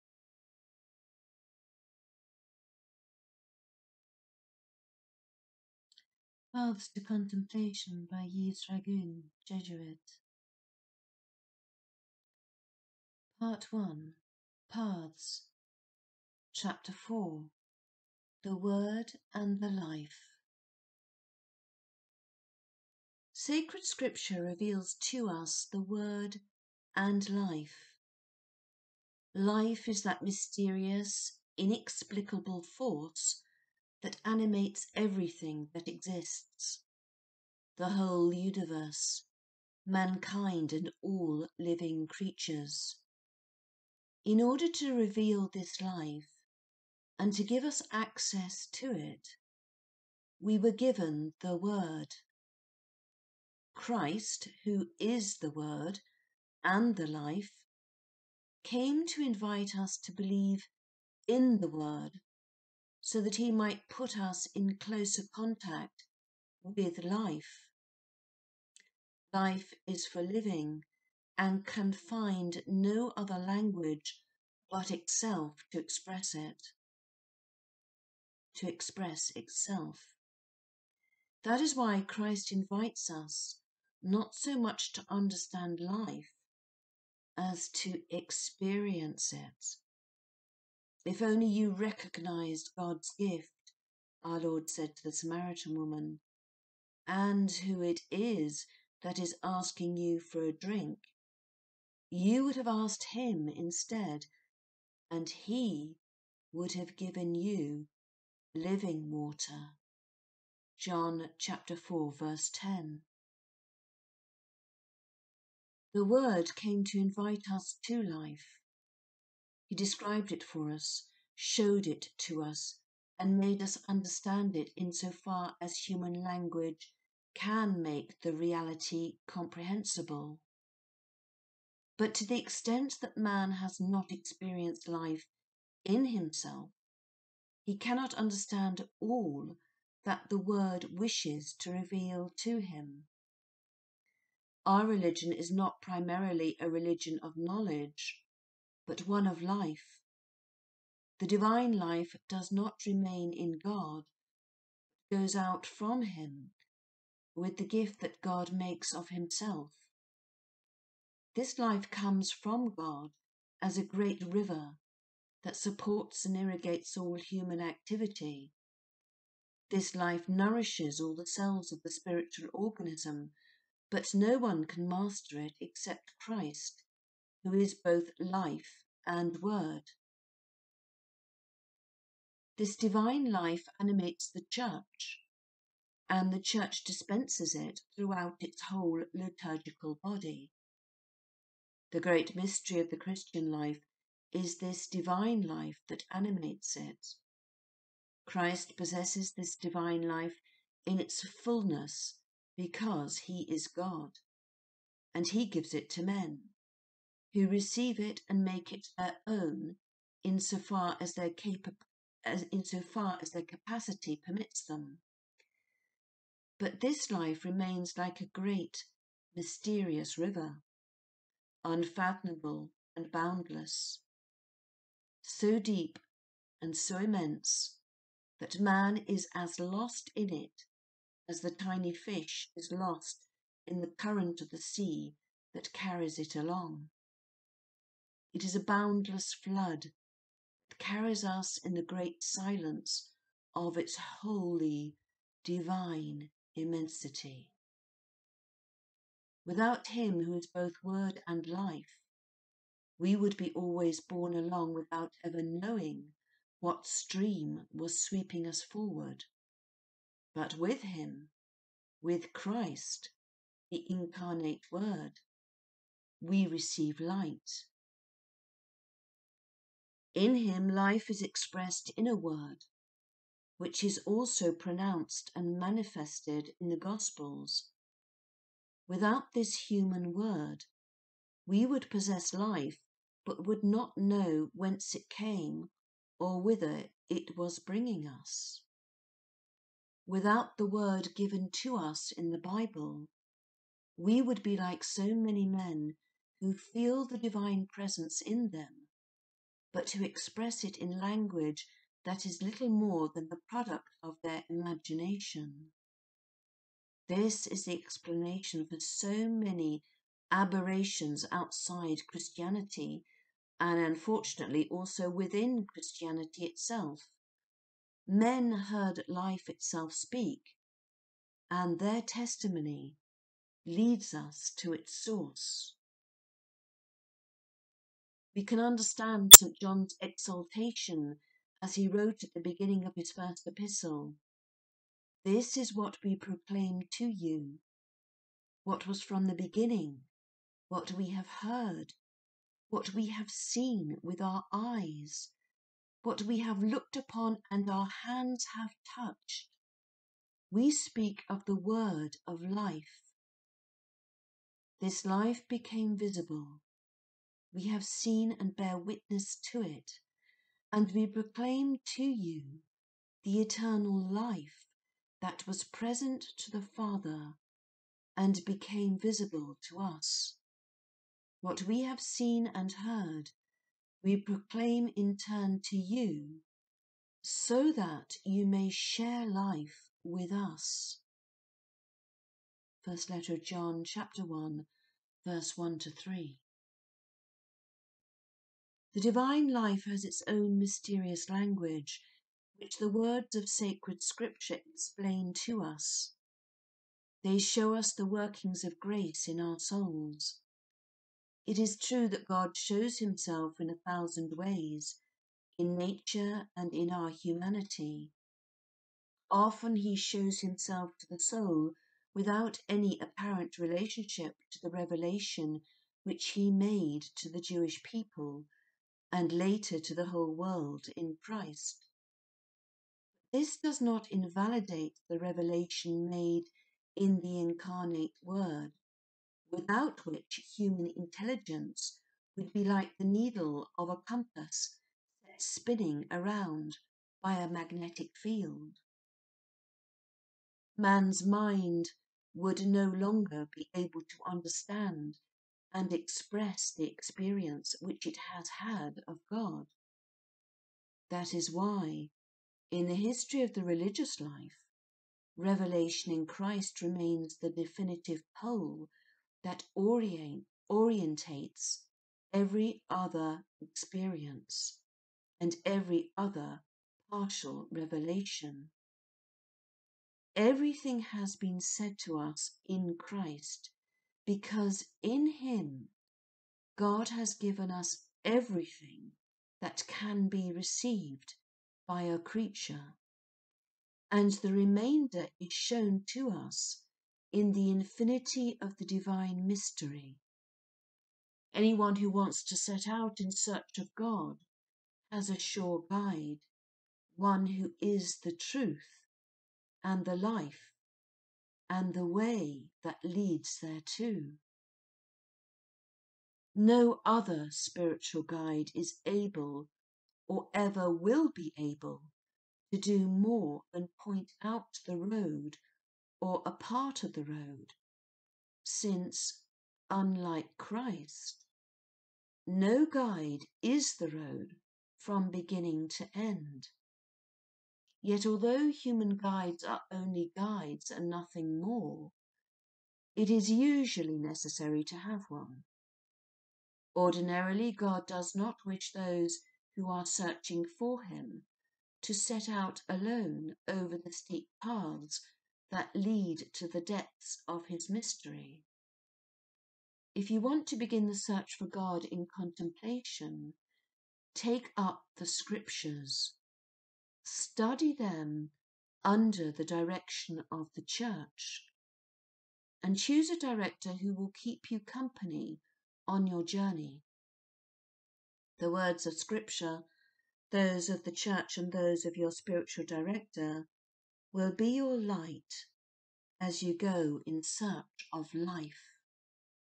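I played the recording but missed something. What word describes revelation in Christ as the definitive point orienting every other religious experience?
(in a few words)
Pole.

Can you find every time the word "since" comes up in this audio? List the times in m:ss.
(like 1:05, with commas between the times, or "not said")
8:38.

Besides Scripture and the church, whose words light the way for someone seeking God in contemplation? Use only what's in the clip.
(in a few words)
Spiritual director.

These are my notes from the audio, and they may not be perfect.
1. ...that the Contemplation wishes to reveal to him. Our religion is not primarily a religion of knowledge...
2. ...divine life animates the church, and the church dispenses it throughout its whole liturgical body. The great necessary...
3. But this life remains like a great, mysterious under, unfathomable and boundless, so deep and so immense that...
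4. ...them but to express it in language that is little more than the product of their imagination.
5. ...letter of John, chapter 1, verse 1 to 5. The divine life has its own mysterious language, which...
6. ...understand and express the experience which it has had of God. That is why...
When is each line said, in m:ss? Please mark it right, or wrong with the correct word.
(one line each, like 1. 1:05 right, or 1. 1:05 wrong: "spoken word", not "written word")
1. 2:20 wrong: "Word", not "Contemplation"
2. 3:02 wrong: "mystery", not "necessary"
3. 3:36 wrong: "river", not "under"
4. 4:58 right
5. 6:23 wrong: "3", not "5"
6. 7:24 right.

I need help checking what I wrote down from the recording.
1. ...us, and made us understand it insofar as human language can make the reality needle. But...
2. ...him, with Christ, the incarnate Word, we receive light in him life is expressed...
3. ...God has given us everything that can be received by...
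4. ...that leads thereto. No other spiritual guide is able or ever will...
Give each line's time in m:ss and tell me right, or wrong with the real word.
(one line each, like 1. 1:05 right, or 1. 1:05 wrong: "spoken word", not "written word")
1. 2:02 wrong: "comprehensible", not "needle"
2. 4:20 right
3. 7:56 right
4. 8:22 right.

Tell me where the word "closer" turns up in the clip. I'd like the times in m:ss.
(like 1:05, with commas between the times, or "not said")
1:04.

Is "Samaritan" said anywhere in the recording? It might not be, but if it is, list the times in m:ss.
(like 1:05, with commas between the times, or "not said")
1:35.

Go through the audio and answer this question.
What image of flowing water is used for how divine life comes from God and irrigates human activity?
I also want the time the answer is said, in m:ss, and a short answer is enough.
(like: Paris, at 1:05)
A great river, at 2:43.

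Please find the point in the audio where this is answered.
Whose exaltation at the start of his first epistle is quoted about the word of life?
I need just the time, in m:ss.
5:29.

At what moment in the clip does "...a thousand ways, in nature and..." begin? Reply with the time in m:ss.
6:43.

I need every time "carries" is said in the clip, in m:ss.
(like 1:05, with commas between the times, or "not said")
3:55, 4:00.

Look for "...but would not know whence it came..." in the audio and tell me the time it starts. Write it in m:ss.
4:43.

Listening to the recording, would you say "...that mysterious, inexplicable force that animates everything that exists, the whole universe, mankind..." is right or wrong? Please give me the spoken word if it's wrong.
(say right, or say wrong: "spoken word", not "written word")
right.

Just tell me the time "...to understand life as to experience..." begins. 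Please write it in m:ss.
1:24.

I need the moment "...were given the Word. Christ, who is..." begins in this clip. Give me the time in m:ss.
0:50.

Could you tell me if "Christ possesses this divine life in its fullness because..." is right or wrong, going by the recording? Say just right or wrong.
right.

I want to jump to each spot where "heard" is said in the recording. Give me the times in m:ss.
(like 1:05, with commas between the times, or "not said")
5:18, 5:41, 6:12.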